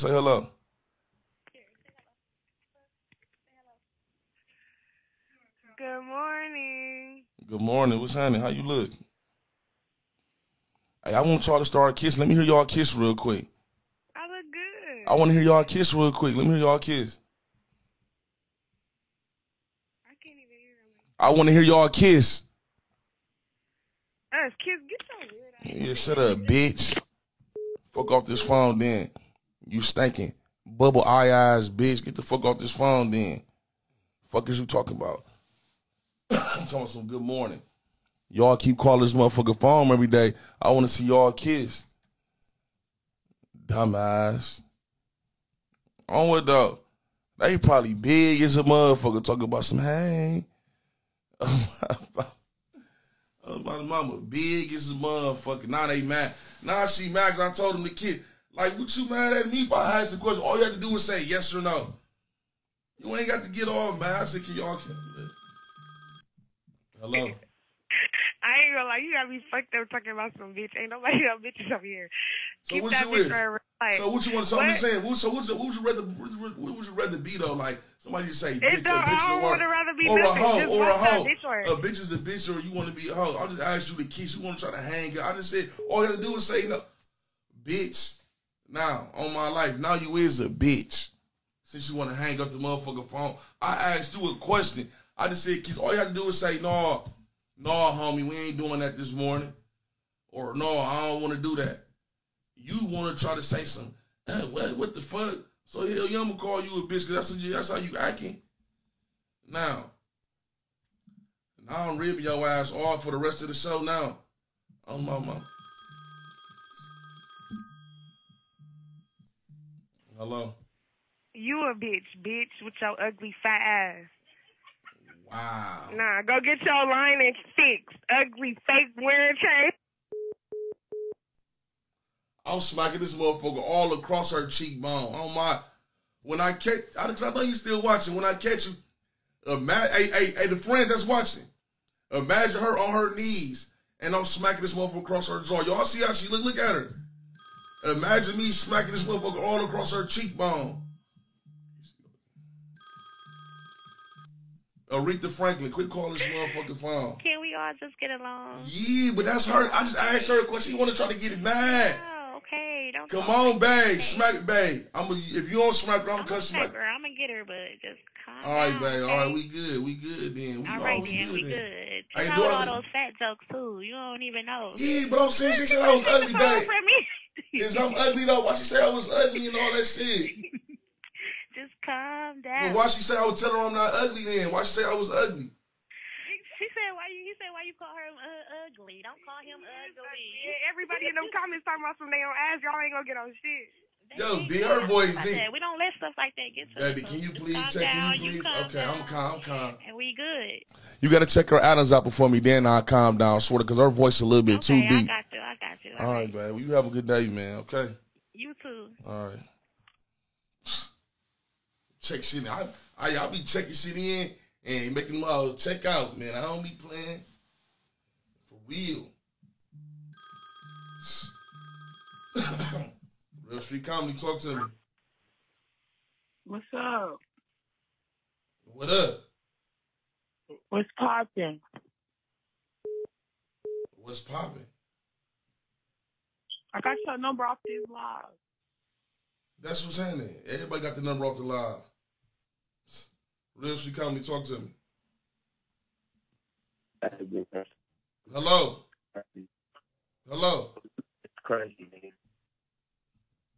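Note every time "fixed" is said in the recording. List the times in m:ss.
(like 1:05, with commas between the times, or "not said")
2:07.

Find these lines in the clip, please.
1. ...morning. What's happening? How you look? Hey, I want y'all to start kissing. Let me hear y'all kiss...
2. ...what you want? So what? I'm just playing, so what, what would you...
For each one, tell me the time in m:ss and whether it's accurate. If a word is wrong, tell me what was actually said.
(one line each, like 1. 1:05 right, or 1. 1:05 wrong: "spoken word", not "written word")
1. 0:07 right
2. 1:14 wrong: "saying", not "playing".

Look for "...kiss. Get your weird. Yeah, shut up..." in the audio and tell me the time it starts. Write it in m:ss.
0:24.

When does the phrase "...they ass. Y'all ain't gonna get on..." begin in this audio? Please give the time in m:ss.
3:12.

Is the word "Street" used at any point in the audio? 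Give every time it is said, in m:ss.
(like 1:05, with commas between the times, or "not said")
3:43, 4:03.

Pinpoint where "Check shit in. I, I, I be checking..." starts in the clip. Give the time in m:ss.
3:32.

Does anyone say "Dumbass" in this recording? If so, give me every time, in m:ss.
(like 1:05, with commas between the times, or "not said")
0:43.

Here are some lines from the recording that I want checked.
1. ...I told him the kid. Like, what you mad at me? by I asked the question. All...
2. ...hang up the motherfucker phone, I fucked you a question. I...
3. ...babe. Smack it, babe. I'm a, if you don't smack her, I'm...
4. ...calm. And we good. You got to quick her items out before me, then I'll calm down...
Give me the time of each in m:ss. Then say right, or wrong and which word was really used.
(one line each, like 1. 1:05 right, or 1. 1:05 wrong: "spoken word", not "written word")
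1. 0:57 right
2. 1:32 wrong: "asked", not "fucked"
3. 2:43 right
4. 3:19 wrong: "check", not "quick".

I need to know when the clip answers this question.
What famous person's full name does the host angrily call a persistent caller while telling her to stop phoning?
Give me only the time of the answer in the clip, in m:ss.
2:34.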